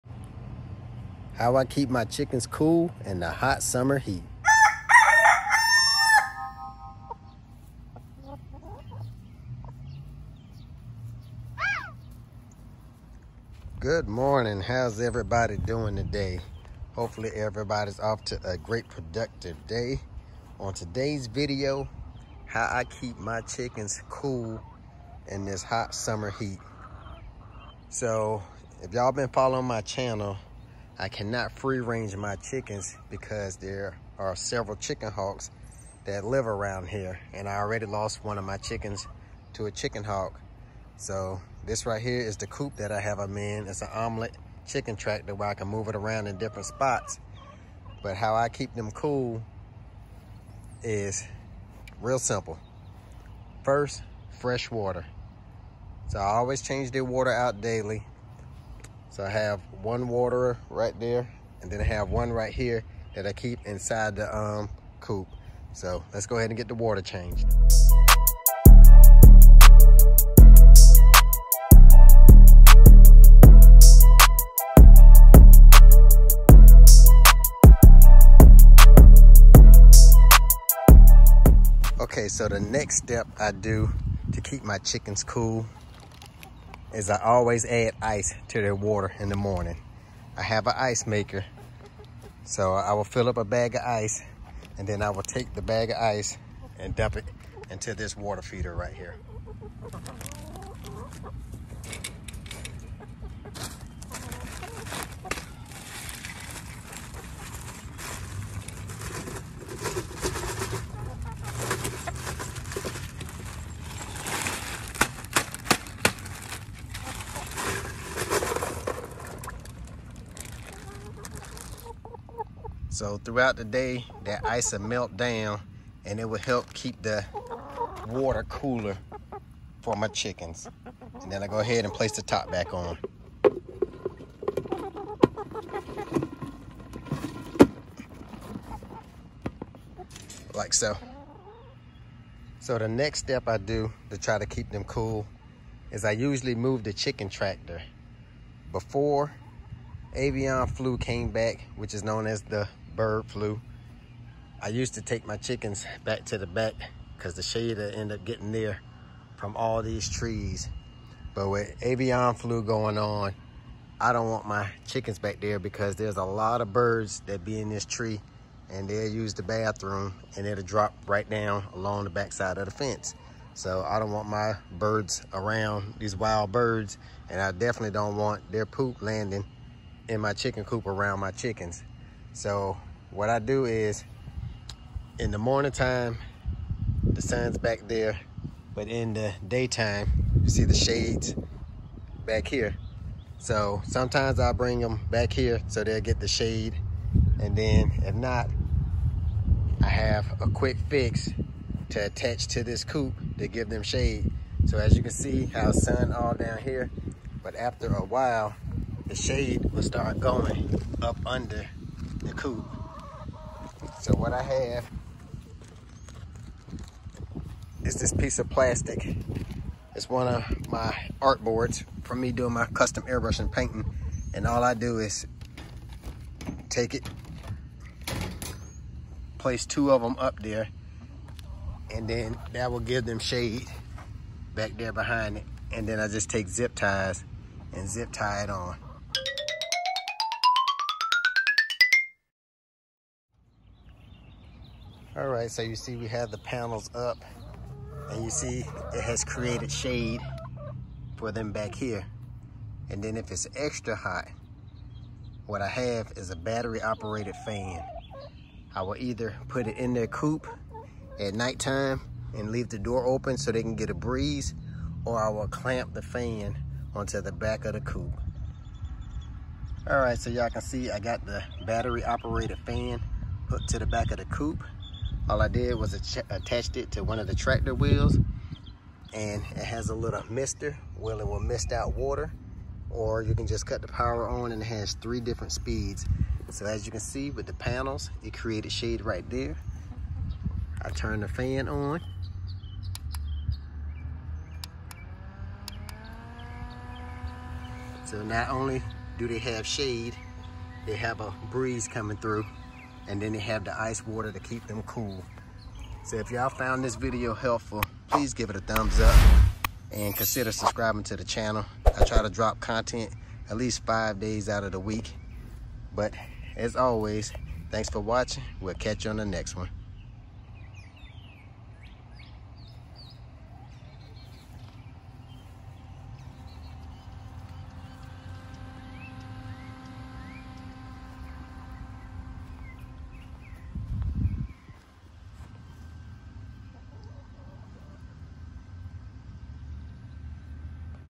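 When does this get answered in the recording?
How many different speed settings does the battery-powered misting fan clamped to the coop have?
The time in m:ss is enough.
4:44.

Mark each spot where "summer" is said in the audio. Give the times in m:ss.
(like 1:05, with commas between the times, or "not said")
0:03, 0:25.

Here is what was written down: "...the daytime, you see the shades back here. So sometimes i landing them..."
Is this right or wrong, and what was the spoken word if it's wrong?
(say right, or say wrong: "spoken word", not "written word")
wrong: "bring", not "landing".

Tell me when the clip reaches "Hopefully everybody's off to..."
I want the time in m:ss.
0:16.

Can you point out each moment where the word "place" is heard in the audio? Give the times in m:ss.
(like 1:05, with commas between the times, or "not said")
2:11, 3:49.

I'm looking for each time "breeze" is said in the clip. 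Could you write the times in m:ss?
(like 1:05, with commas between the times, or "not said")
4:23, 5:01.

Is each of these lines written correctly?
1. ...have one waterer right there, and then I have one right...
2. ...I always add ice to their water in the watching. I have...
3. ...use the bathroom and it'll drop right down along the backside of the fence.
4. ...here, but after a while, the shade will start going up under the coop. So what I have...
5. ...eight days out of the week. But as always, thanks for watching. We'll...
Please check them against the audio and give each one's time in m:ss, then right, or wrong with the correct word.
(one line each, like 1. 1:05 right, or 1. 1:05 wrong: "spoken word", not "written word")
1. 0:59 right
2. 1:27 wrong: "morning", not "watching"
3. 2:49 right
4. 3:26 right
5. 5:13 wrong: "five", not "eight".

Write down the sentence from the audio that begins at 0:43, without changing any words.
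It's an Omlet chicken tractor where I can move it around in different spots.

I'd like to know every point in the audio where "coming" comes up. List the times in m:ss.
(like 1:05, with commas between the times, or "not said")
5:01.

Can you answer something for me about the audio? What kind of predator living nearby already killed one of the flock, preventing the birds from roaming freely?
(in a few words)
Chicken hawk.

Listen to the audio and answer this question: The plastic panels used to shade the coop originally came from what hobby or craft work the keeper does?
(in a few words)
Custom airbrushing painting.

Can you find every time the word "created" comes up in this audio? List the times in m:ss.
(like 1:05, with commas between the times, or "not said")
4:09, 4:48.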